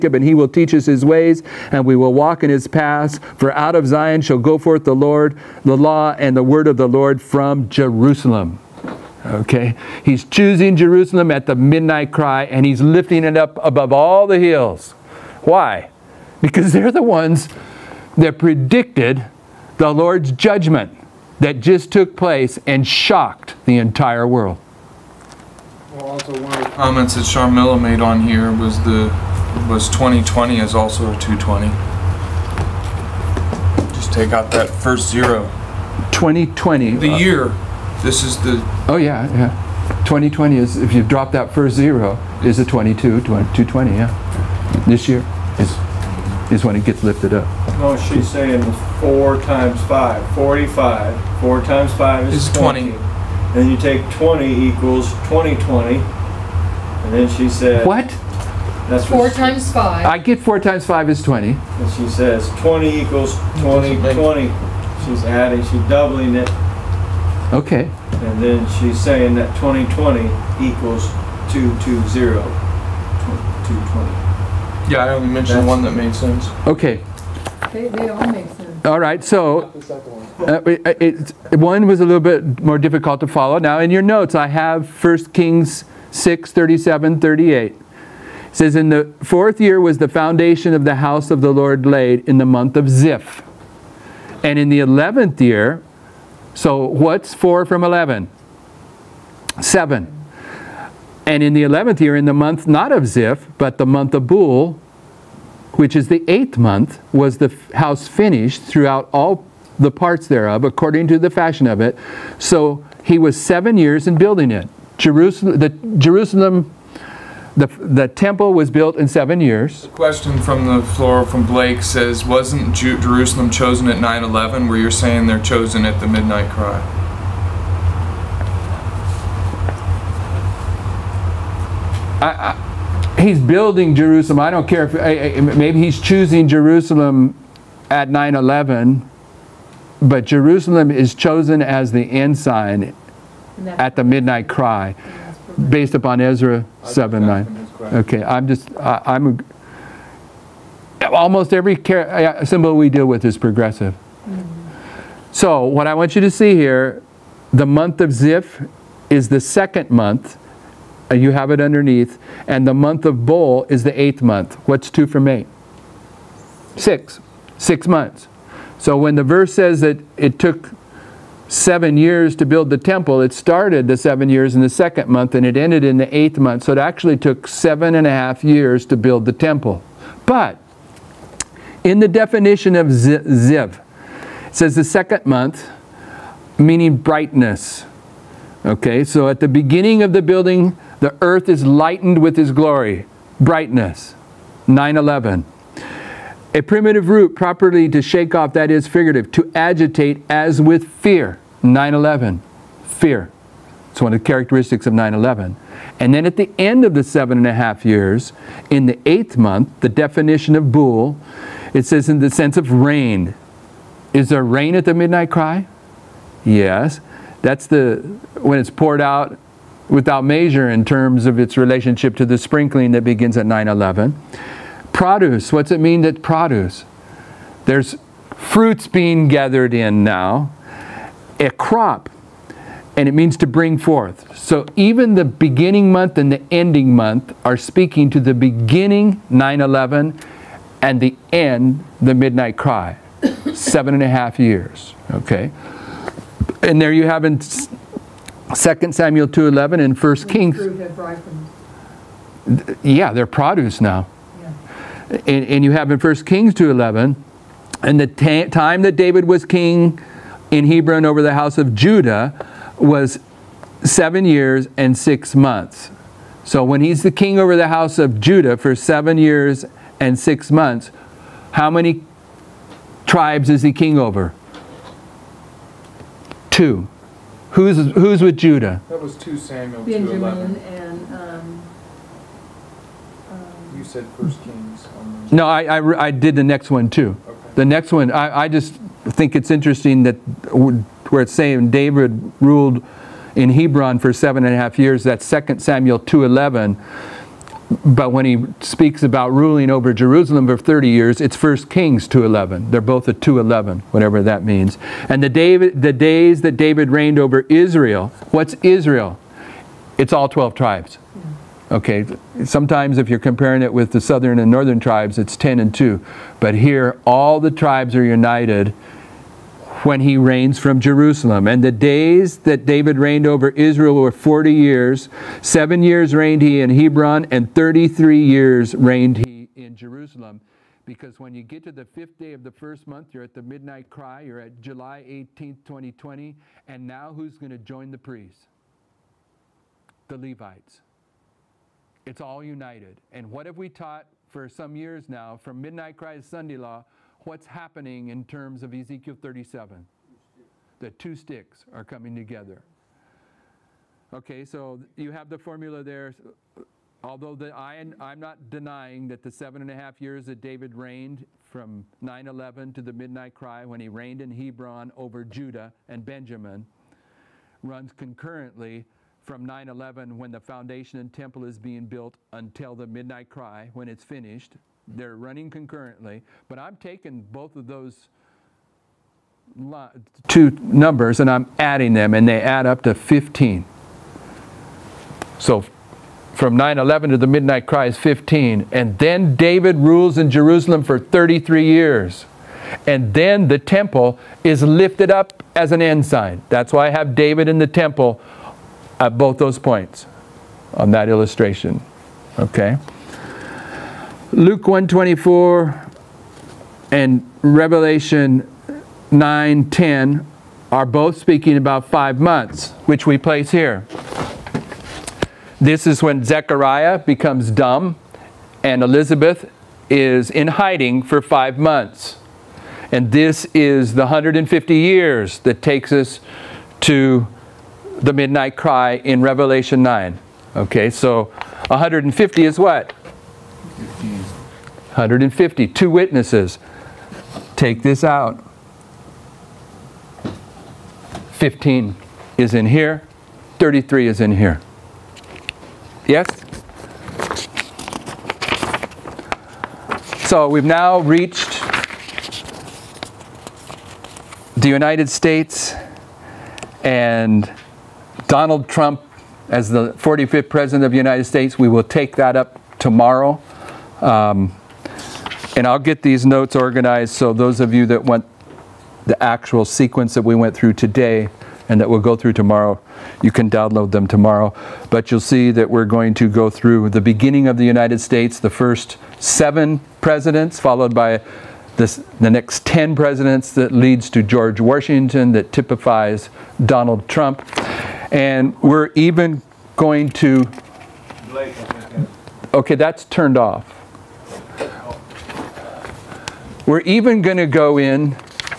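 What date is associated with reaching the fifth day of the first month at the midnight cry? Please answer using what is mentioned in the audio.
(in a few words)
July 18, 2020.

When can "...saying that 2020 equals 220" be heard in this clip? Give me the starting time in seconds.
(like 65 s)
69 s.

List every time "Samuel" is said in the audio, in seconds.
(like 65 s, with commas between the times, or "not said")
248 s, 279 s, 295 s.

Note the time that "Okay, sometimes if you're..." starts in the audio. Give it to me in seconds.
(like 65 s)
311 s.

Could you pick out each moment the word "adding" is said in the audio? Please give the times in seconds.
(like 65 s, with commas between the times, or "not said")
65 s, 381 s.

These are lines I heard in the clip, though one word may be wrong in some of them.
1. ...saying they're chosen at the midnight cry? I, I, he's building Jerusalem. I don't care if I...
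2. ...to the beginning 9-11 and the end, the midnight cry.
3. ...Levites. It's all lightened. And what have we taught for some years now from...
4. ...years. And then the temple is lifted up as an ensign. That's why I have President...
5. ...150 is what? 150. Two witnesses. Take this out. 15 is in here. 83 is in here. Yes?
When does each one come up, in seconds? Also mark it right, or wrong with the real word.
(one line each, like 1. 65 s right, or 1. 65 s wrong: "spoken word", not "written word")
1. 124 s right
2. 238 s right
3. 340 s wrong: "united", not "lightened"
4. 391 s wrong: "David", not "President"
5. 431 s wrong: "33", not "83".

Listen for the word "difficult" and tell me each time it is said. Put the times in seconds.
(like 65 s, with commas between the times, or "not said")
82 s.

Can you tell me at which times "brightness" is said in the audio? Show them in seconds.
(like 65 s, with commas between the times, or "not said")
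186 s, 193 s.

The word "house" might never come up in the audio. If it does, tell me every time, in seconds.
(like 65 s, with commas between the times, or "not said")
90 s, 107 s, 261 s, 267 s.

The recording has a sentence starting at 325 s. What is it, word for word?
Seven years reigned he in Hebron, and 33 years reigned he in Jerusalem.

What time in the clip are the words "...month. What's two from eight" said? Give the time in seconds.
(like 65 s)
164 s.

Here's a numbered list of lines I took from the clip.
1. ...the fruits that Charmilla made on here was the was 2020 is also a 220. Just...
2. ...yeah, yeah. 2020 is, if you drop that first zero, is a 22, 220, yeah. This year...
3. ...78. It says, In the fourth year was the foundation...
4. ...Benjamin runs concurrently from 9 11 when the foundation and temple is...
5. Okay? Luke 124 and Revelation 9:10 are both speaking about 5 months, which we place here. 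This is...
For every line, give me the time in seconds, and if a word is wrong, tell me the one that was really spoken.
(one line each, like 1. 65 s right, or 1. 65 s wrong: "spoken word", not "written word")
1. 26 s wrong: "comments", not "fruits"
2. 38 s right
3. 87 s wrong: "38", not "78"
4. 366 s right
5. 402 s right.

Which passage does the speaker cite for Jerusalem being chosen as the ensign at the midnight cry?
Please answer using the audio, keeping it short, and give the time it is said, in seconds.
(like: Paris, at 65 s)
Ezra 7:9, at 146 s.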